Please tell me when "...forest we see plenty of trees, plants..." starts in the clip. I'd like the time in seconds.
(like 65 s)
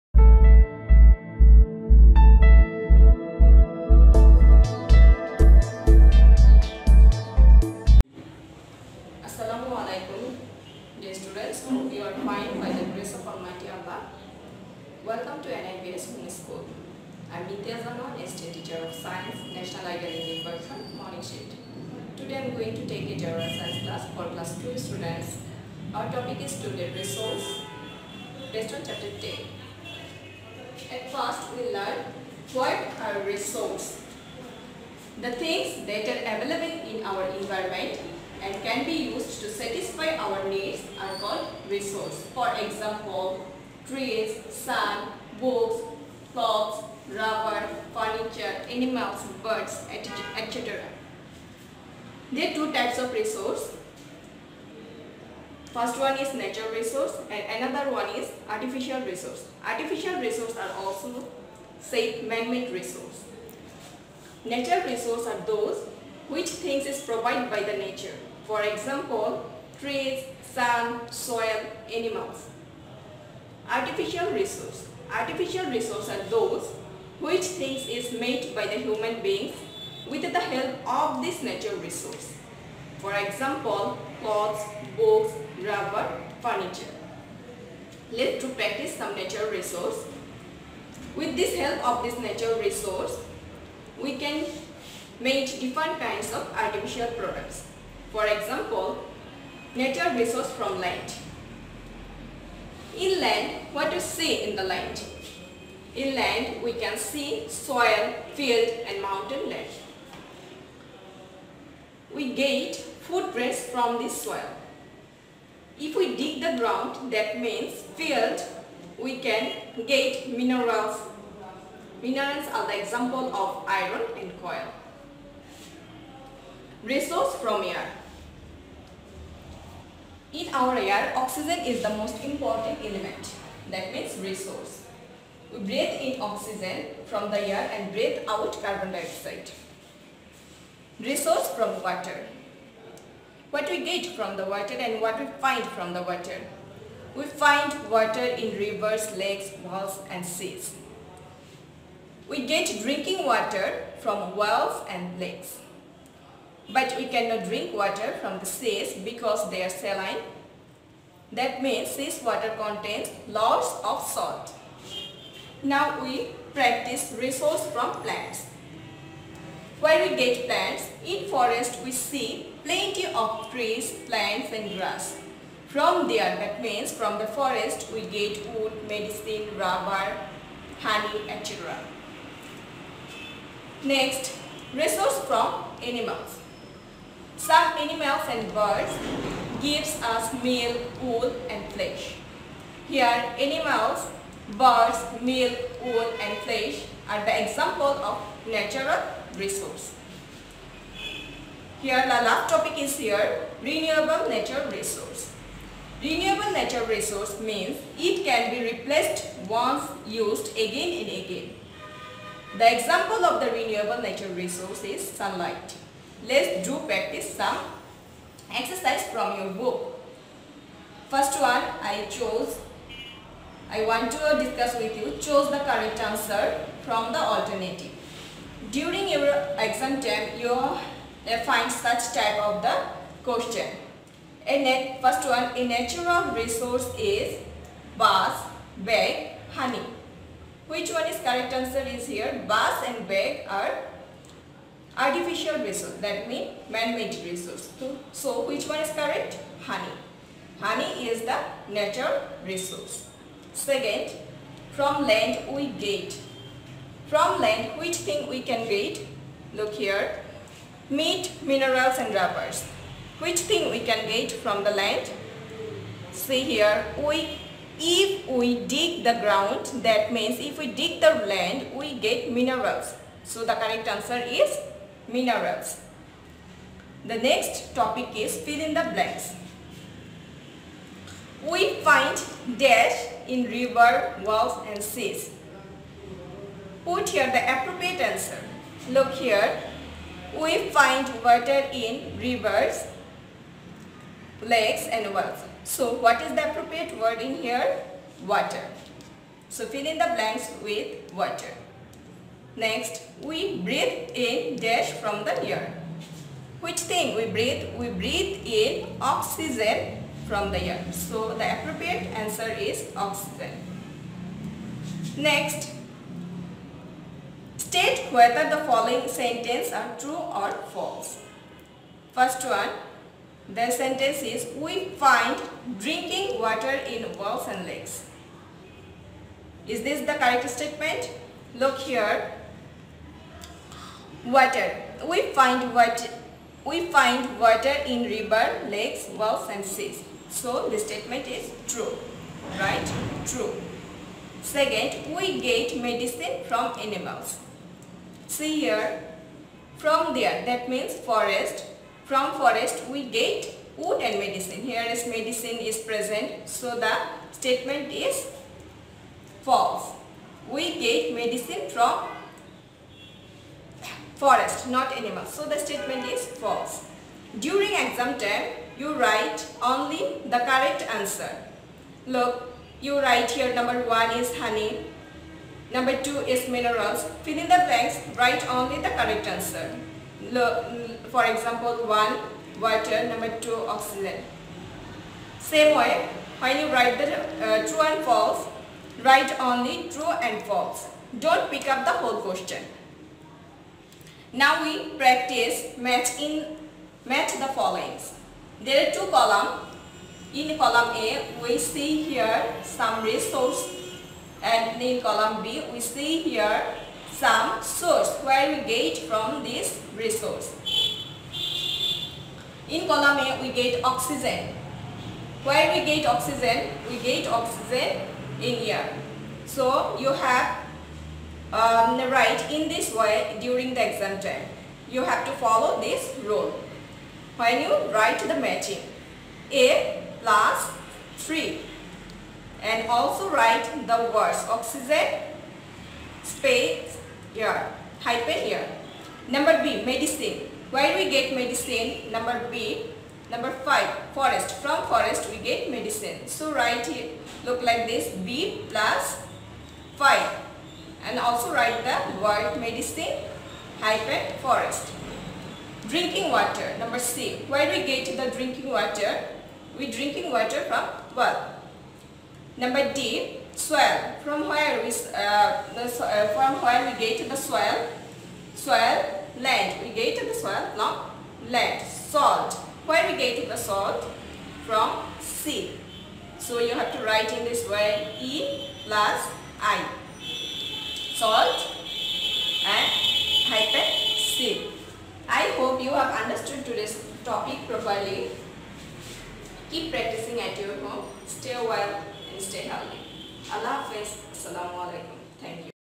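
171 s.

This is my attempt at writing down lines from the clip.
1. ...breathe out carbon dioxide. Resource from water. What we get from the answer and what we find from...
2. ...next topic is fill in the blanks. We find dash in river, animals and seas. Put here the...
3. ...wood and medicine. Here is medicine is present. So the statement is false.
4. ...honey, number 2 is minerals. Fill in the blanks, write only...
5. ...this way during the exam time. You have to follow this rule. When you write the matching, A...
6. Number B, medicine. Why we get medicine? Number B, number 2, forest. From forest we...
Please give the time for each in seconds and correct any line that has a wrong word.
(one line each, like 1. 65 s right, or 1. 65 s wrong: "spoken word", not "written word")
1. 137 s wrong: "water", not "answer"
2. 277 s wrong: "walls", not "animals"
3. 353 s right
4. 374 s right
5. 422 s right
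6. 439 s wrong: "5", not "2".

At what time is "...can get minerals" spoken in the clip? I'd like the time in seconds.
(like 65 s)
119 s.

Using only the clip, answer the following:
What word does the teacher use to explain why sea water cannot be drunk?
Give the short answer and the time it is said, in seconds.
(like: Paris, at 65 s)
Saline, at 159 s.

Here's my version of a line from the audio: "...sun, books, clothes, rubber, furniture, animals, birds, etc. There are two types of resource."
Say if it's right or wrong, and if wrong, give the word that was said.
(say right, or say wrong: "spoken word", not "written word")
right.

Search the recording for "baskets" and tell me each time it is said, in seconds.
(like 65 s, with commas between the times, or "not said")
not said.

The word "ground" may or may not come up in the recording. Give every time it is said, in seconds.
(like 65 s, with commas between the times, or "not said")
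116 s, 269 s.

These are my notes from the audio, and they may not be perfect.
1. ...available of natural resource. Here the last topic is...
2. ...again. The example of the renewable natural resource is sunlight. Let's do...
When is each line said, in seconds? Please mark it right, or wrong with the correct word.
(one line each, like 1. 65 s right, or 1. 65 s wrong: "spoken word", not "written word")
1. 197 s wrong: "example", not "available"
2. 211 s right.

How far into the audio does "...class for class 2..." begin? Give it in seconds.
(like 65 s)
23 s.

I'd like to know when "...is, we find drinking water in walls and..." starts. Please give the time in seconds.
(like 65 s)
324 s.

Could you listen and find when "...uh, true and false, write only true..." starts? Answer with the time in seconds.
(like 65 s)
387 s.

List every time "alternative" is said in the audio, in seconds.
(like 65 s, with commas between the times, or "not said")
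227 s.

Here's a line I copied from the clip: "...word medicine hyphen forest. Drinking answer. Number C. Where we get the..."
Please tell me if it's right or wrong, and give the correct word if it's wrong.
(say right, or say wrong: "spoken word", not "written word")
wrong: "water", not "answer".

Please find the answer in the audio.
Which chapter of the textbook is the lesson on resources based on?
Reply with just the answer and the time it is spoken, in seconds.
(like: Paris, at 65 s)
10, at 28 s.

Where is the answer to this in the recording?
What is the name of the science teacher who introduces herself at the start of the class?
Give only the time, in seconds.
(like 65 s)
17 s.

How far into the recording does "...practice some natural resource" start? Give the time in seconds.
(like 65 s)
88 s.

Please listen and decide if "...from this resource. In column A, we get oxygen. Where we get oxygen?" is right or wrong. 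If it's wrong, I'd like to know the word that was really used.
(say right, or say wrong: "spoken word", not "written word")
right.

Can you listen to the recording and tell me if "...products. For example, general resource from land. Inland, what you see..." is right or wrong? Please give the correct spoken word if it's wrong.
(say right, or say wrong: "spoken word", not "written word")
wrong: "natural", not "general".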